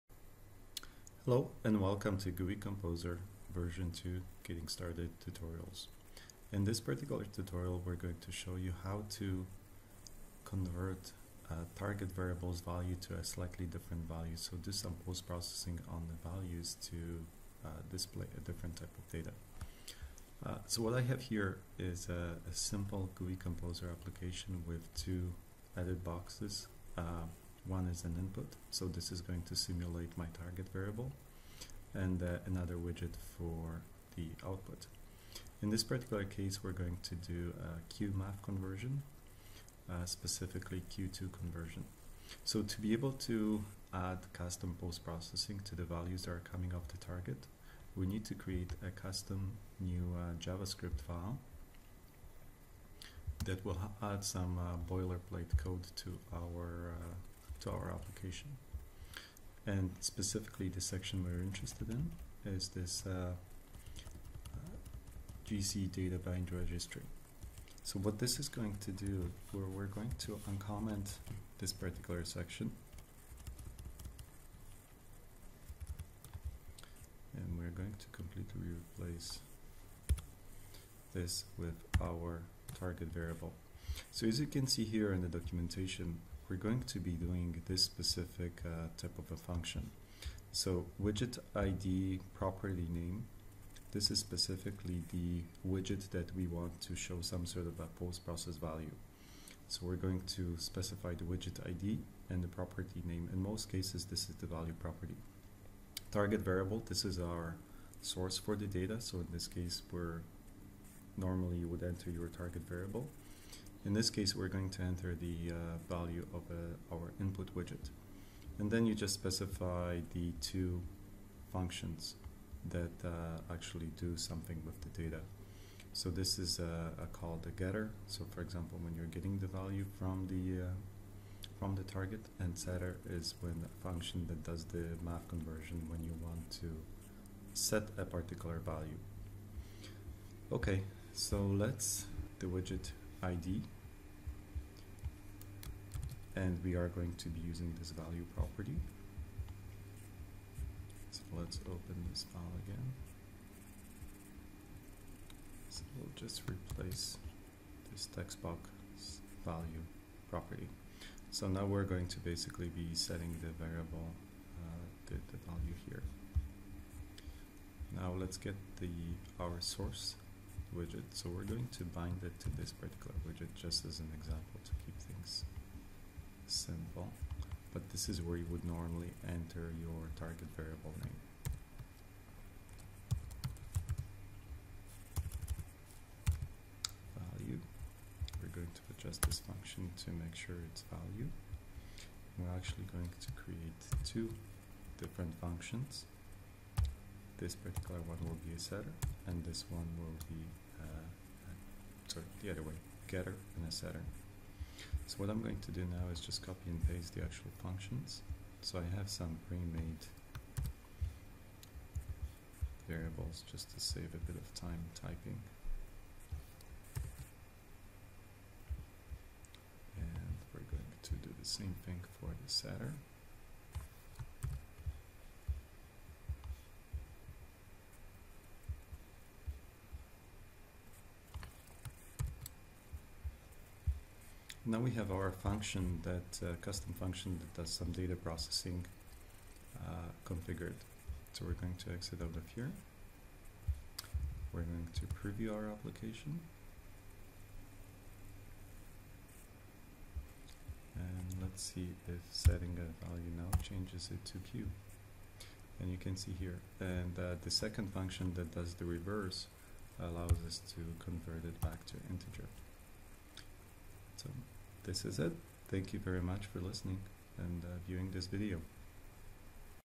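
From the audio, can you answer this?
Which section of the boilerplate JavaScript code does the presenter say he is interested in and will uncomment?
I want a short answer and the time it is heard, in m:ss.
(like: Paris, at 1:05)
GC data bind registry, at 1:05.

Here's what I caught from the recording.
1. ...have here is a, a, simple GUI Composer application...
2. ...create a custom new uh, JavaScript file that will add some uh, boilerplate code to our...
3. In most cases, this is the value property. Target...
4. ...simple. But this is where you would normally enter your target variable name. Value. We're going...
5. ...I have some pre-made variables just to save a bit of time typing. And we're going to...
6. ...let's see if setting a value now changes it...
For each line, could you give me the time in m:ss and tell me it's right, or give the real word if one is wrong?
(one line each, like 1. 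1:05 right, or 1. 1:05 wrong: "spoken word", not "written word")
1. 0:21 right
2. 0:48 right
3. 1:43 right
4. 2:56 right
5. 3:28 right
6. 4:11 right.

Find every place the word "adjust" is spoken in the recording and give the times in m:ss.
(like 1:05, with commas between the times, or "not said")
3:08.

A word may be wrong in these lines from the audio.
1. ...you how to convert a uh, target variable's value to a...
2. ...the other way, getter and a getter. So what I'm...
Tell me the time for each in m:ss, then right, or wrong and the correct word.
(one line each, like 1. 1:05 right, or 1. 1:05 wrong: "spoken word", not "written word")
1. 0:08 right
2. 3:22 wrong: "setter", not "getter".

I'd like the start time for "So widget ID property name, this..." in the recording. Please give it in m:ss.
1:30.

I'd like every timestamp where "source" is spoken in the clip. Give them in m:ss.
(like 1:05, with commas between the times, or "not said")
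1:48, 2:49.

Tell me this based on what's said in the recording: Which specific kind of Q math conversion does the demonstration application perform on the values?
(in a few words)
Q2 conversion.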